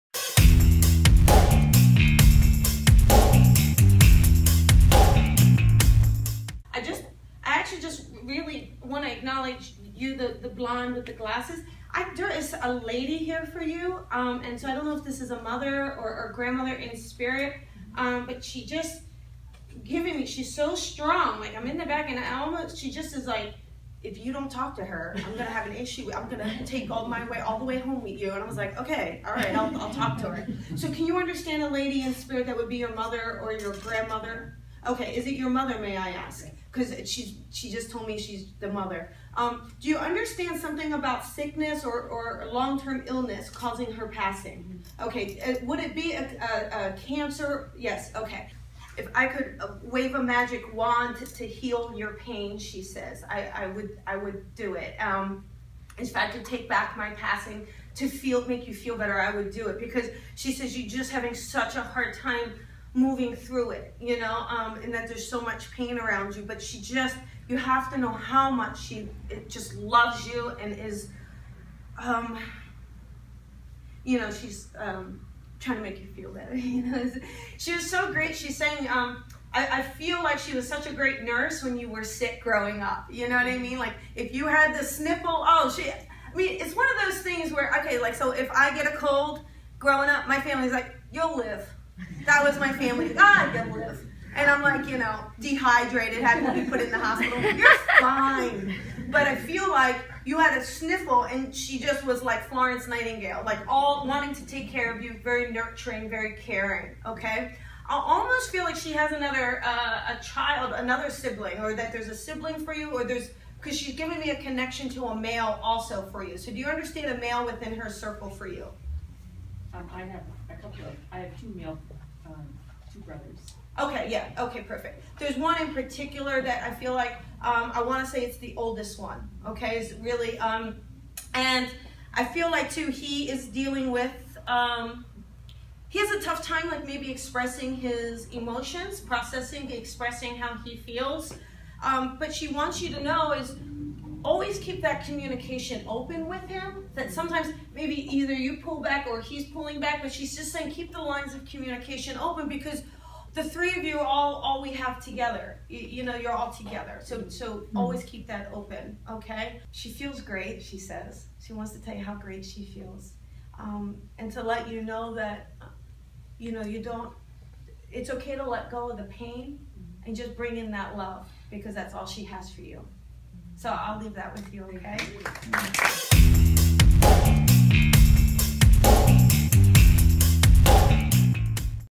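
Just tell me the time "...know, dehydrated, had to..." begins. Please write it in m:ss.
1:34.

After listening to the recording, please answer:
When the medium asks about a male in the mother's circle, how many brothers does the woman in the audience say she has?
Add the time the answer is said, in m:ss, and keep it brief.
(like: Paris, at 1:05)
2, at 2:02.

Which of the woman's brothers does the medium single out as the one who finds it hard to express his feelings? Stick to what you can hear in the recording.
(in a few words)
The oldest one.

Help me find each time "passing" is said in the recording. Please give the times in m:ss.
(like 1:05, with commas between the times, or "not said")
0:44, 0:57.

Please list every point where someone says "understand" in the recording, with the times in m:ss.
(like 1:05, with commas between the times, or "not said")
0:31, 0:39, 1:56.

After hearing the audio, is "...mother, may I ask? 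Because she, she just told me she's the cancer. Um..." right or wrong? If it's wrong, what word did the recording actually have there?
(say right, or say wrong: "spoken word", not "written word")
wrong: "mother", not "cancer".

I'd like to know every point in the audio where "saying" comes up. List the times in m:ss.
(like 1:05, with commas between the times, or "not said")
1:18, 2:30.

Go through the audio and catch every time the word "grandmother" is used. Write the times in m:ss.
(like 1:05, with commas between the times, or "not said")
0:16, 0:33.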